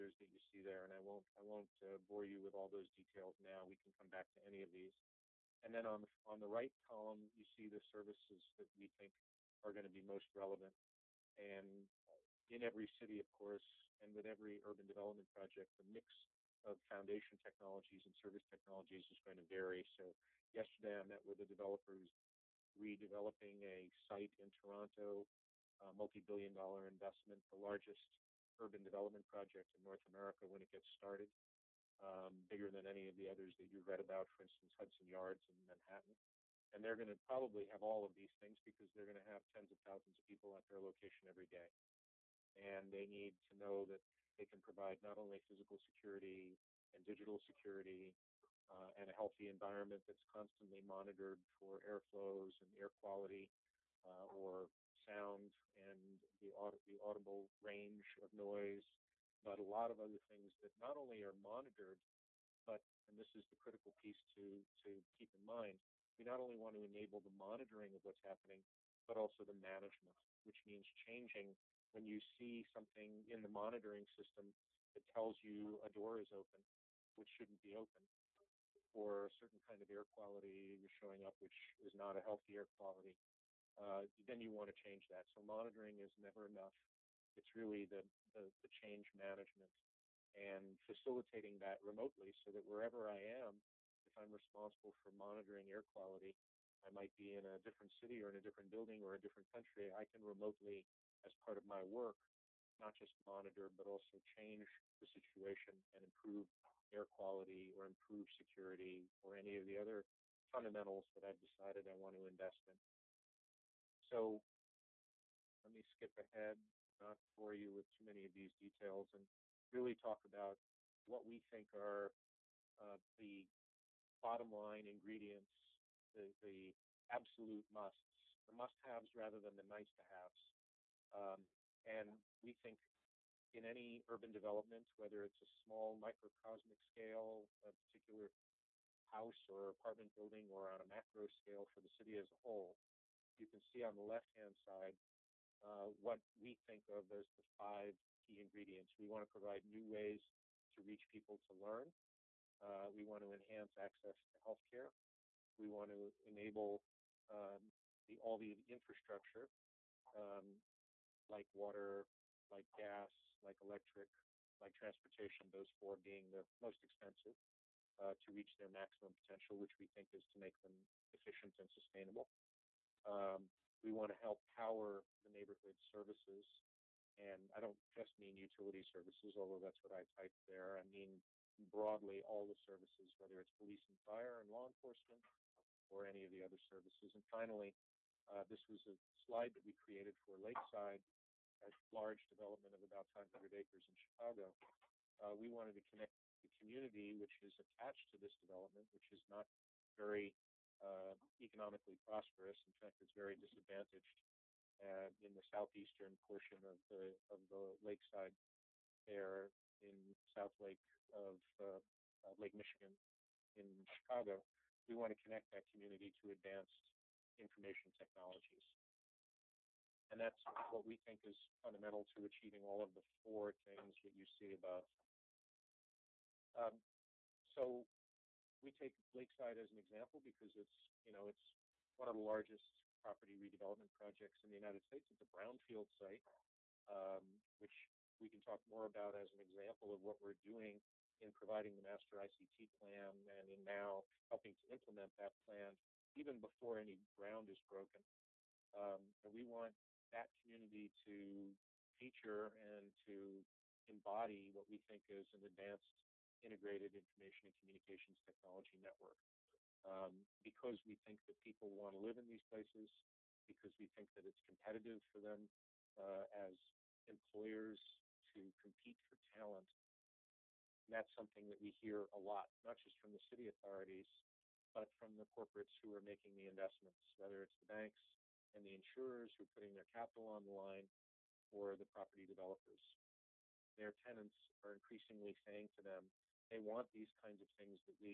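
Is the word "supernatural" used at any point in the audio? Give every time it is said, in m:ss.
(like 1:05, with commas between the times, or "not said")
not said.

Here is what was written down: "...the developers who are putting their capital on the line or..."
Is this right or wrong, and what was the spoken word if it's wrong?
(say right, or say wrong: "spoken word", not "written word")
wrong: "insurers", not "developers".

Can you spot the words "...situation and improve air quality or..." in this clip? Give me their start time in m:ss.
1:45.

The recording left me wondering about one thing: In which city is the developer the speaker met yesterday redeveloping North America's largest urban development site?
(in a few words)
Toronto.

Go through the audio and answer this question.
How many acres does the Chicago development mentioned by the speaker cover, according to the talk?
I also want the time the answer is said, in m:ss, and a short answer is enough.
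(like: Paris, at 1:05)
500, at 3:13.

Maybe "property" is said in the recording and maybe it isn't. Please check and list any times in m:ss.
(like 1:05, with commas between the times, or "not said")
3:53, 4:41.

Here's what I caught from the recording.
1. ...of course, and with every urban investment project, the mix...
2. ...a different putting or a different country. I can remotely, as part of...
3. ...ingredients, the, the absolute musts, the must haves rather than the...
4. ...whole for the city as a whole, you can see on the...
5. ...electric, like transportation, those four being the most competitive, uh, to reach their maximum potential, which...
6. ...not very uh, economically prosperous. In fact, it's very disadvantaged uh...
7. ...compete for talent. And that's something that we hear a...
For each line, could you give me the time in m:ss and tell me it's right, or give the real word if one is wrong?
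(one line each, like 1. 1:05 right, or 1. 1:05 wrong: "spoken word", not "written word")
1. 0:13 wrong: "development", not "investment"
2. 1:38 wrong: "building", not "putting"
3. 2:04 right
4. 2:21 wrong: "scale", not "whole"
5. 2:43 wrong: "expensive", not "competitive"
6. 3:19 right
7. 4:28 right.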